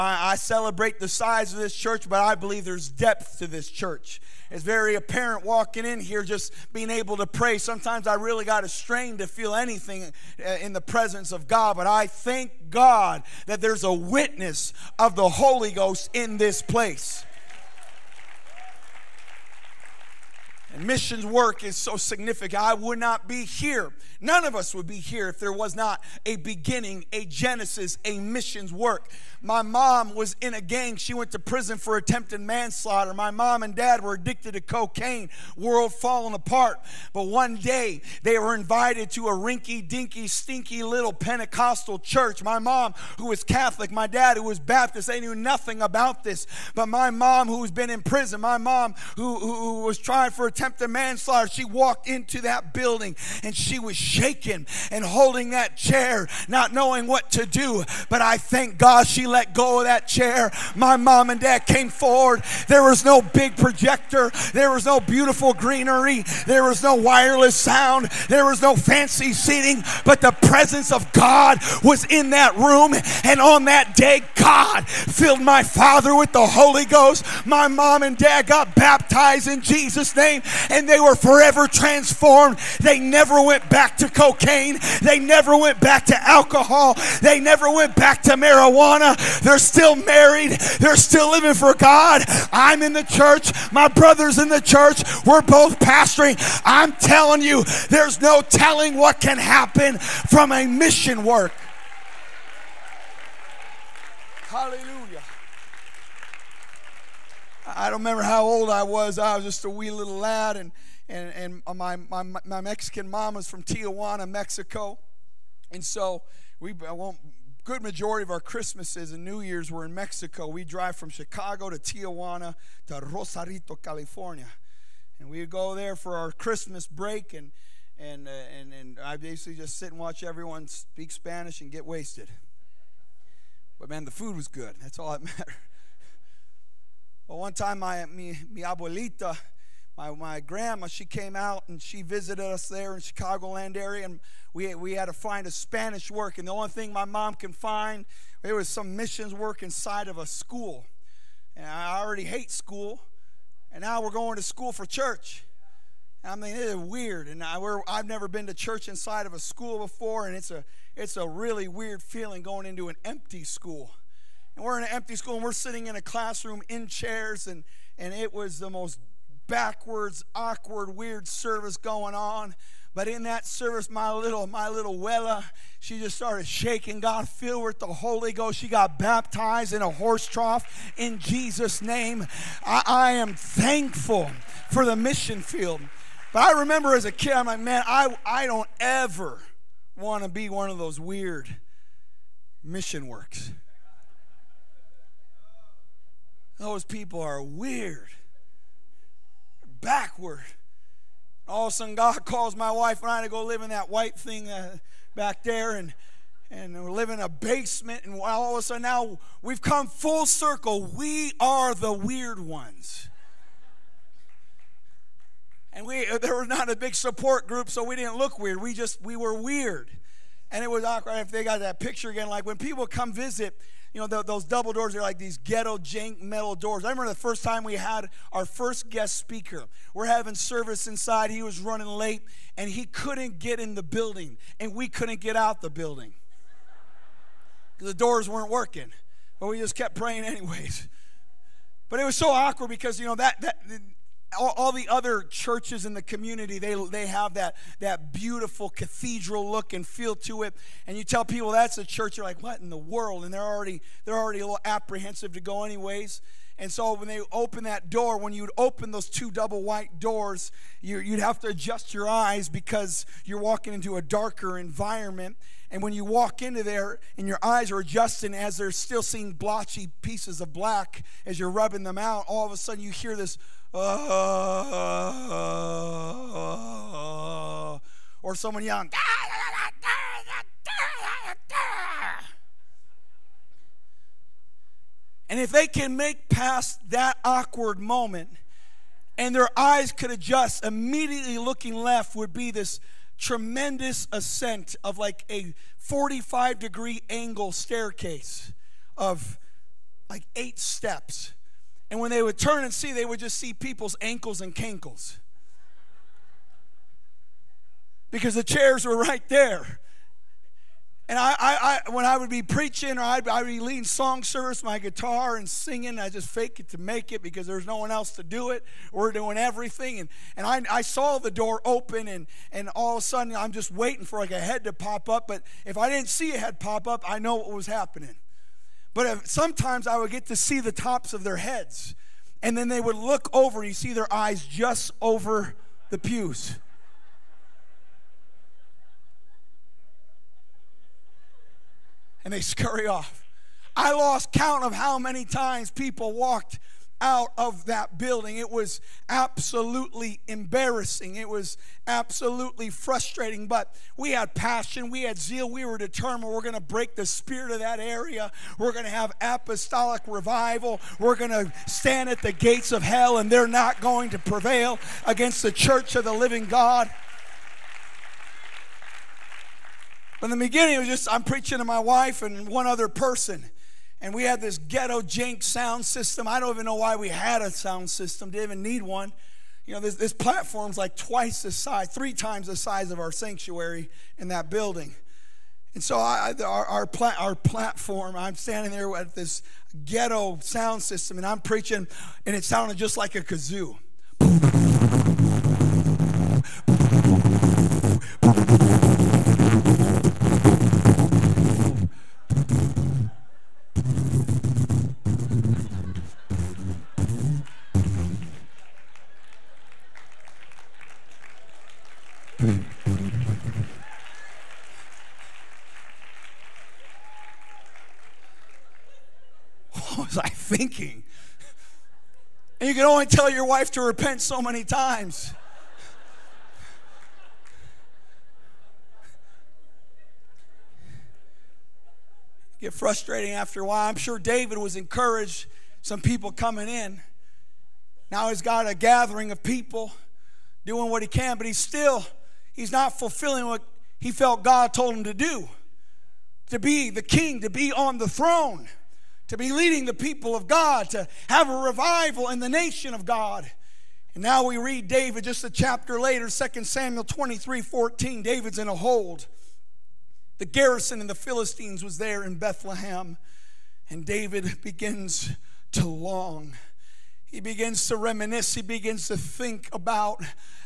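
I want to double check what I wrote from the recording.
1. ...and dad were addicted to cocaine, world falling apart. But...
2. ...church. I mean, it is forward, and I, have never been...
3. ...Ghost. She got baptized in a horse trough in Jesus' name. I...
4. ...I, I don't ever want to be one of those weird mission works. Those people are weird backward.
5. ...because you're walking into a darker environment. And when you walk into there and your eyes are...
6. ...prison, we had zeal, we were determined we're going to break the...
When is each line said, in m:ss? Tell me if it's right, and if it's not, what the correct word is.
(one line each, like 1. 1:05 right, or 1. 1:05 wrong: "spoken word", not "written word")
1. 0:33 right
2. 2:34 wrong: "weird", not "forward"
3. 2:58 right
4. 3:07 right
5. 4:22 right
6. 5:54 wrong: "passion", not "prison".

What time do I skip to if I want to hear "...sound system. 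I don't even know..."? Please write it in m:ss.
6:15.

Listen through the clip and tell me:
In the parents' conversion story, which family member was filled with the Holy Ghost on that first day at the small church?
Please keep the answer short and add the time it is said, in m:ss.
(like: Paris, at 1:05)
father, at 1:15.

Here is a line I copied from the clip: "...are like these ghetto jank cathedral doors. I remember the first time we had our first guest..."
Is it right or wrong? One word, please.
wrong.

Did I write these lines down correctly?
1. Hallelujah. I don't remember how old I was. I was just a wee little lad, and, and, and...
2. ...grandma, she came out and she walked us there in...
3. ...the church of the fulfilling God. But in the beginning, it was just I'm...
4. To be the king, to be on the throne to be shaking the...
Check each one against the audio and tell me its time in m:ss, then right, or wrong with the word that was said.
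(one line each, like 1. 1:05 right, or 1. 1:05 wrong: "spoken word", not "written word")
1. 1:44 right
2. 2:20 wrong: "visited", not "walked"
3. 6:05 wrong: "living", not "fulfilling"
4. 7:26 wrong: "leading", not "shaking".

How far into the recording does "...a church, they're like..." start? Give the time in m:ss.
4:11.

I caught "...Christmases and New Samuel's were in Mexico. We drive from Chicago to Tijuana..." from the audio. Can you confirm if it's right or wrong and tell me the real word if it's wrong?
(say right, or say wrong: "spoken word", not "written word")
wrong: "Year", not "Samuel".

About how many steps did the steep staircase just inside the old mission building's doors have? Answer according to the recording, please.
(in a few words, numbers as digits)
8.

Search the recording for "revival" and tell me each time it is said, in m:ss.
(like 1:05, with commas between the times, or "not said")
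6:00, 7:31.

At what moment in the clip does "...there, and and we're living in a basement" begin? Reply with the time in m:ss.
3:25.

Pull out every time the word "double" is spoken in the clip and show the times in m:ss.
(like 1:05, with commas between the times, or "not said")
3:44, 4:19.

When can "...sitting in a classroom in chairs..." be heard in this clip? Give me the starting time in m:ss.
2:45.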